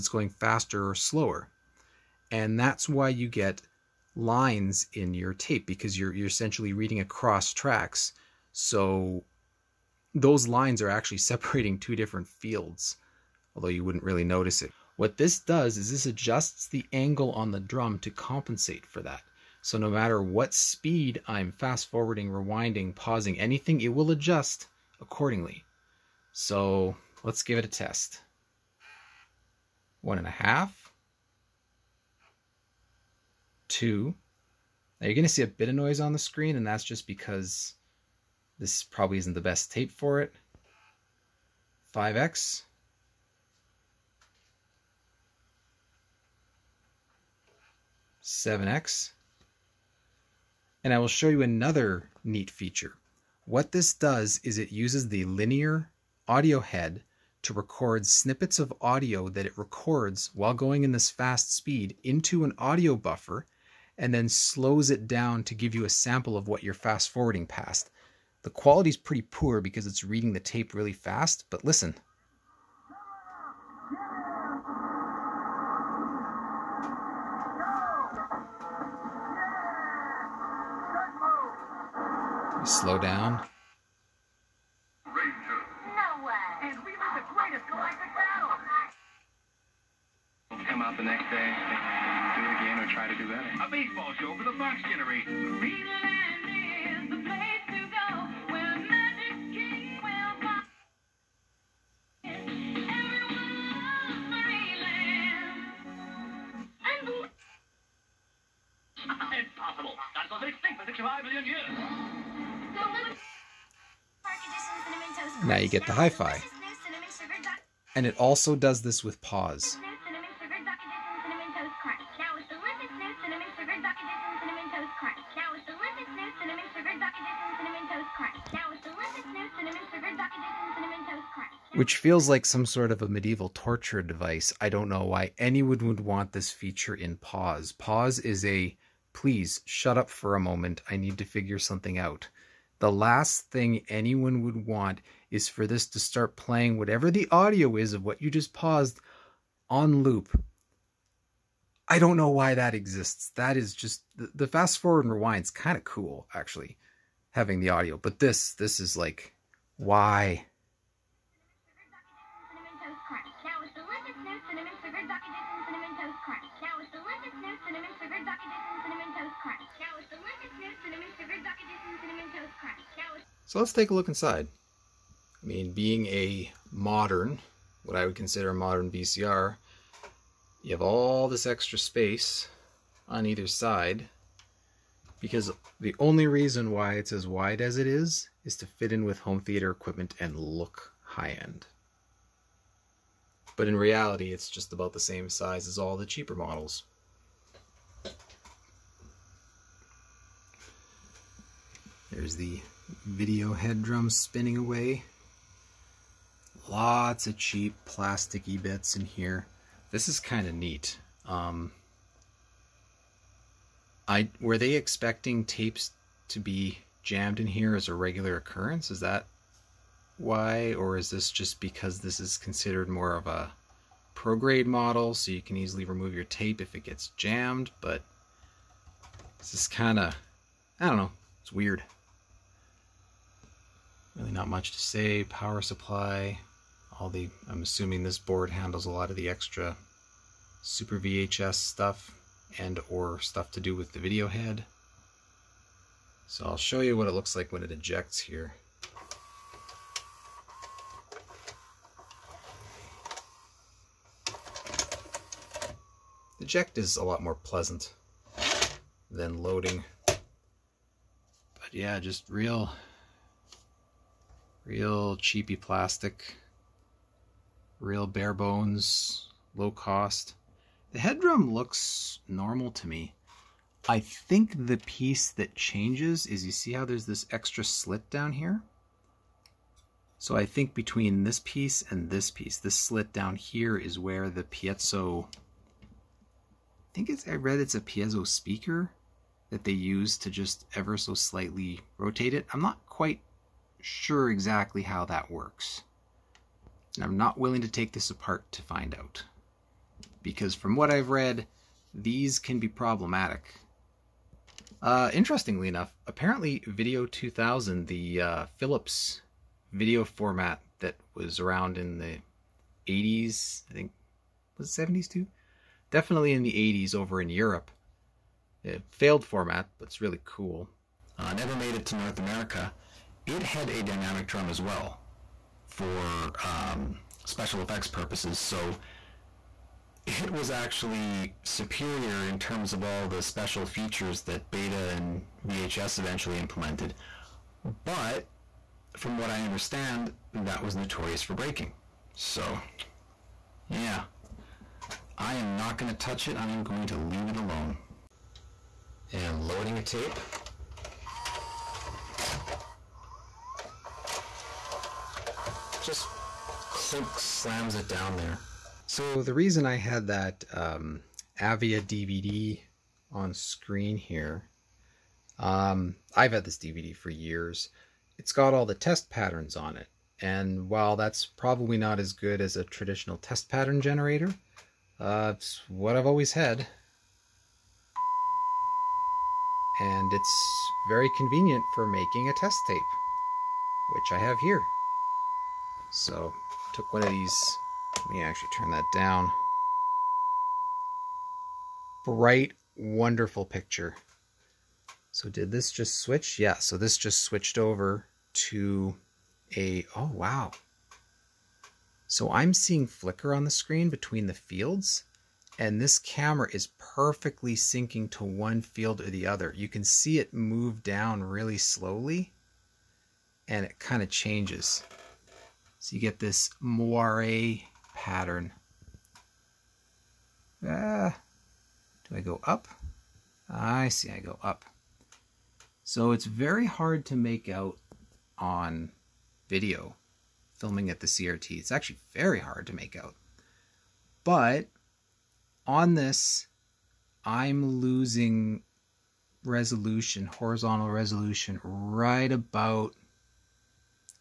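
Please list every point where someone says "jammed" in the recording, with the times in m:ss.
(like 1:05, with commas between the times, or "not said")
3:37, 3:47.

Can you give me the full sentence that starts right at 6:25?
So, took one of these, let me actually turn that down.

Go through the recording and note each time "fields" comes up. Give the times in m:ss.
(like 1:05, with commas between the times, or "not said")
0:12, 6:44, 6:48.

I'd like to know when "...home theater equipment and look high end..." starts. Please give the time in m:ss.
3:09.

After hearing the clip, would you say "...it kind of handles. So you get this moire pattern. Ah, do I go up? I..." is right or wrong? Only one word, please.
wrong.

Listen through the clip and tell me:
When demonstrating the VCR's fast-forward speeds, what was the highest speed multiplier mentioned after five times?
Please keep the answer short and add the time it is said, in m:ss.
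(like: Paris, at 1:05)
7x, at 0:48.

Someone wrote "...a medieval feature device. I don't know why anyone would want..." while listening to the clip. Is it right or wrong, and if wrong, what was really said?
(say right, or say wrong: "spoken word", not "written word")
wrong: "torture", not "feature".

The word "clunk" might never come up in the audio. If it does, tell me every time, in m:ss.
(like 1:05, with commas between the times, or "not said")
5:56.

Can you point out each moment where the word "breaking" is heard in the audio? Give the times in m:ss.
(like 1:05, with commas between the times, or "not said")
5:41.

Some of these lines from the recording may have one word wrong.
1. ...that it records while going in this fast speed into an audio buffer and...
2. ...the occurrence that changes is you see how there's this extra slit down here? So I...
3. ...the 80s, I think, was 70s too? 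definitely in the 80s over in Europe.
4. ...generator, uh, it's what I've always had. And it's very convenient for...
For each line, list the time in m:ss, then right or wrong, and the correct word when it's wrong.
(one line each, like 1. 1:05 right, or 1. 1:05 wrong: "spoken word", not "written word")
1. 0:59 right
2. 4:34 wrong: "piece", not "occurrence"
3. 5:11 right
4. 6:13 right.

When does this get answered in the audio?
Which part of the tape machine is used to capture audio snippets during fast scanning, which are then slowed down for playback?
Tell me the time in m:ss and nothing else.
0:55.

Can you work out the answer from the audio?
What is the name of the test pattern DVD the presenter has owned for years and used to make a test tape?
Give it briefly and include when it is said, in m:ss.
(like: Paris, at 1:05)
Avia, at 6:01.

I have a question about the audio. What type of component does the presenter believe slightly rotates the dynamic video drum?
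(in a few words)
piezo speaker.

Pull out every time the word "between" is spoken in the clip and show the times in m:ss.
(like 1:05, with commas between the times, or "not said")
4:40, 6:43.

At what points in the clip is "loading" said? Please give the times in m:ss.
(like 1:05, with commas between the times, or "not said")
4:19, 5:49.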